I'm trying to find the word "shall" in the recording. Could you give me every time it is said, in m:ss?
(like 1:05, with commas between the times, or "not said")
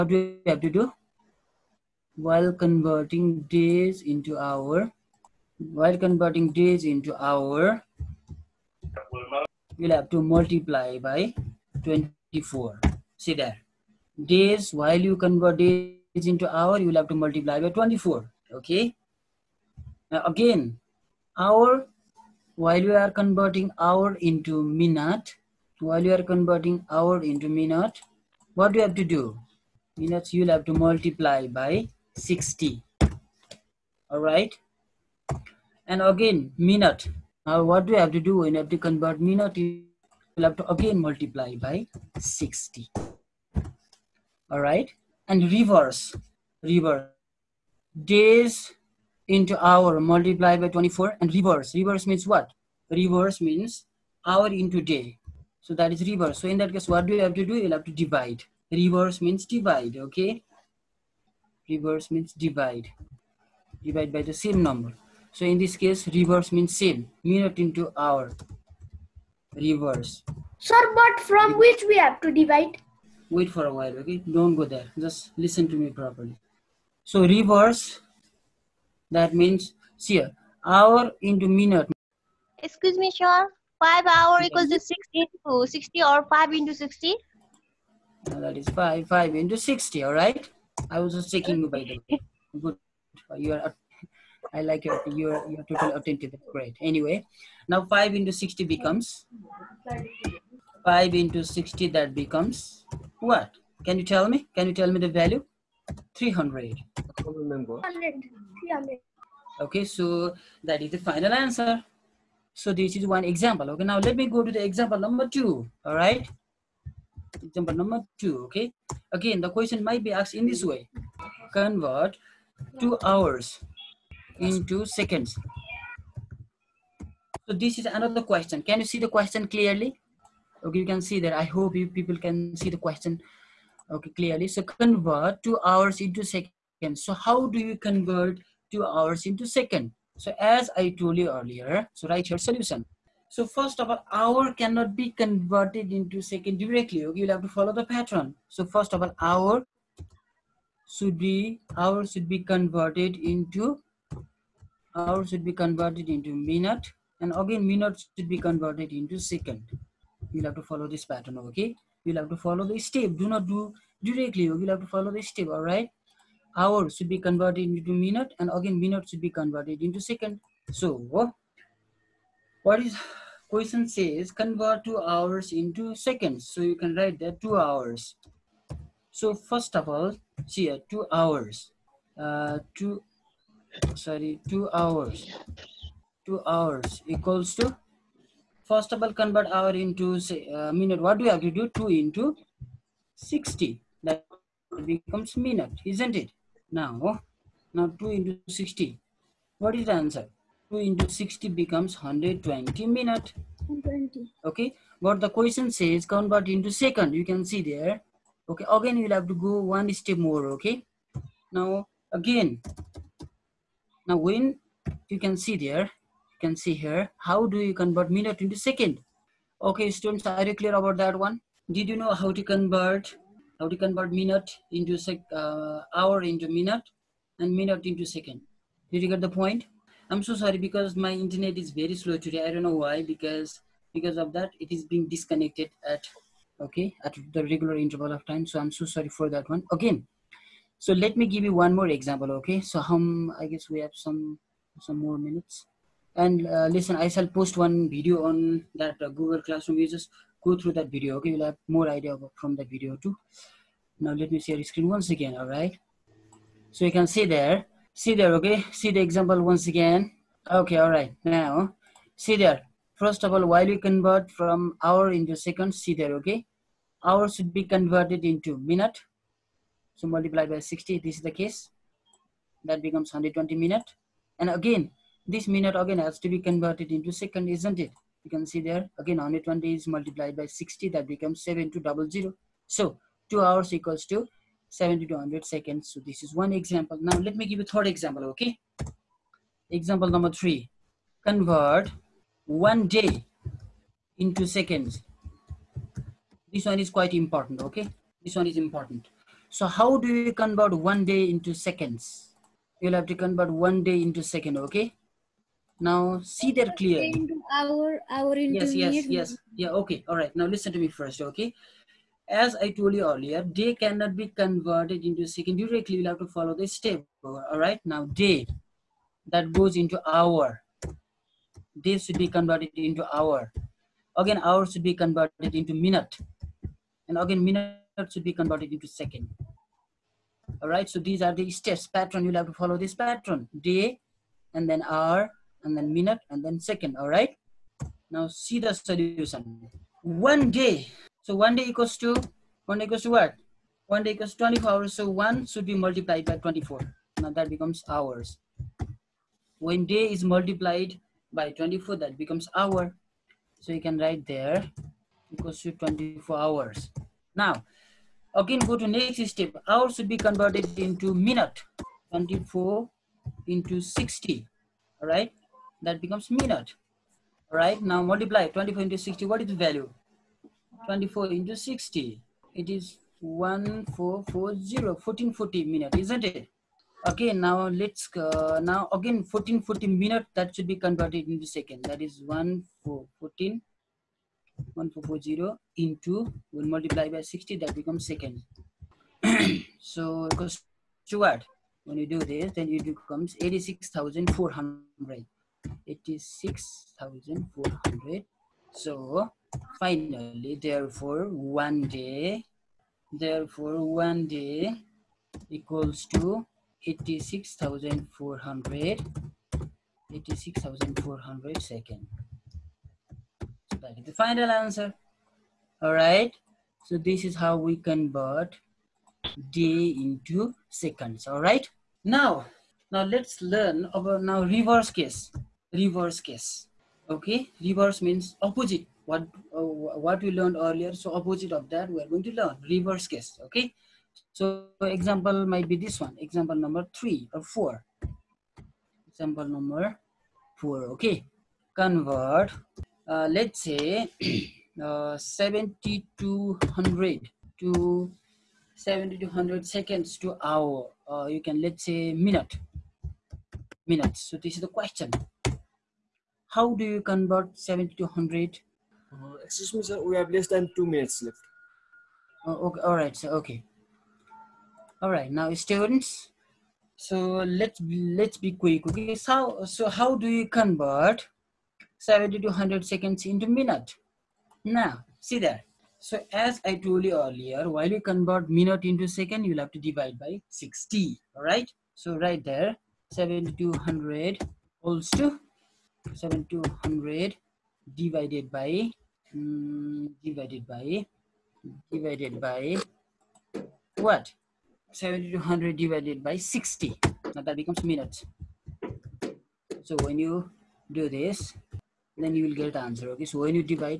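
4:07.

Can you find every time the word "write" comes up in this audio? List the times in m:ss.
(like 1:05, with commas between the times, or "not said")
2:22, 2:56, 5:53.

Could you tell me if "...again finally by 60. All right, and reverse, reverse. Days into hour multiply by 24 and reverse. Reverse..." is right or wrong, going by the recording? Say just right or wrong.
wrong.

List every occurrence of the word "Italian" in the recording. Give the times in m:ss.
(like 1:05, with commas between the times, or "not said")
not said.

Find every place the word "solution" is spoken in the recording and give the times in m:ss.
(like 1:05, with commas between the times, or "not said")
2:22, 5:38.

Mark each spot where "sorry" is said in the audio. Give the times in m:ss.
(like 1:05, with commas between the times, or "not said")
3:03, 3:50, 3:58.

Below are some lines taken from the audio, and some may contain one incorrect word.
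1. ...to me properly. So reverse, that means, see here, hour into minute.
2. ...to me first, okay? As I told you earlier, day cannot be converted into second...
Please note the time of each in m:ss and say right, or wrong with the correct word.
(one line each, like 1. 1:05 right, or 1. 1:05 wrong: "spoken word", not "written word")
1. 1:15 right
2. 5:10 right.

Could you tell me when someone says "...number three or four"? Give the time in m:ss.
7:16.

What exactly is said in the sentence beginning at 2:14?
So convert two hours into seconds.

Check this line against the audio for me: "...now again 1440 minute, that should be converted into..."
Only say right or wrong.
right.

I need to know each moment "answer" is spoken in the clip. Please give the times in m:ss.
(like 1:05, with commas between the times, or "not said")
1:51, 3:19, 6:54, 8:22.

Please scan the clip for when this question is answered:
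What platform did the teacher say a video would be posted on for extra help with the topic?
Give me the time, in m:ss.
4:09.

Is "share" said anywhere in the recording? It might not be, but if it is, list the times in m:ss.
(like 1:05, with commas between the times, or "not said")
4:14.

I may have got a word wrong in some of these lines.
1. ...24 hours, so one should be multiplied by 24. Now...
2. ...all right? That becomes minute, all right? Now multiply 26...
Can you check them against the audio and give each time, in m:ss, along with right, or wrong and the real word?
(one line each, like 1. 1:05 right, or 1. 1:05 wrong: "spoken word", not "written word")
1. 5:44 right
2. 6:05 wrong: "24", not "26".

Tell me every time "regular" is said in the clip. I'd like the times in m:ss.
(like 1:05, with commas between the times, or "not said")
3:57.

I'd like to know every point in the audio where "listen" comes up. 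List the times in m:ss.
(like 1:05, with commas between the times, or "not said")
1:15, 4:06, 5:10.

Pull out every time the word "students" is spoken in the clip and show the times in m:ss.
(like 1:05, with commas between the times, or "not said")
3:39, 7:45.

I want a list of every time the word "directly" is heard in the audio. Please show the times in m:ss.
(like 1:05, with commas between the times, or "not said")
2:26, 2:44, 5:15.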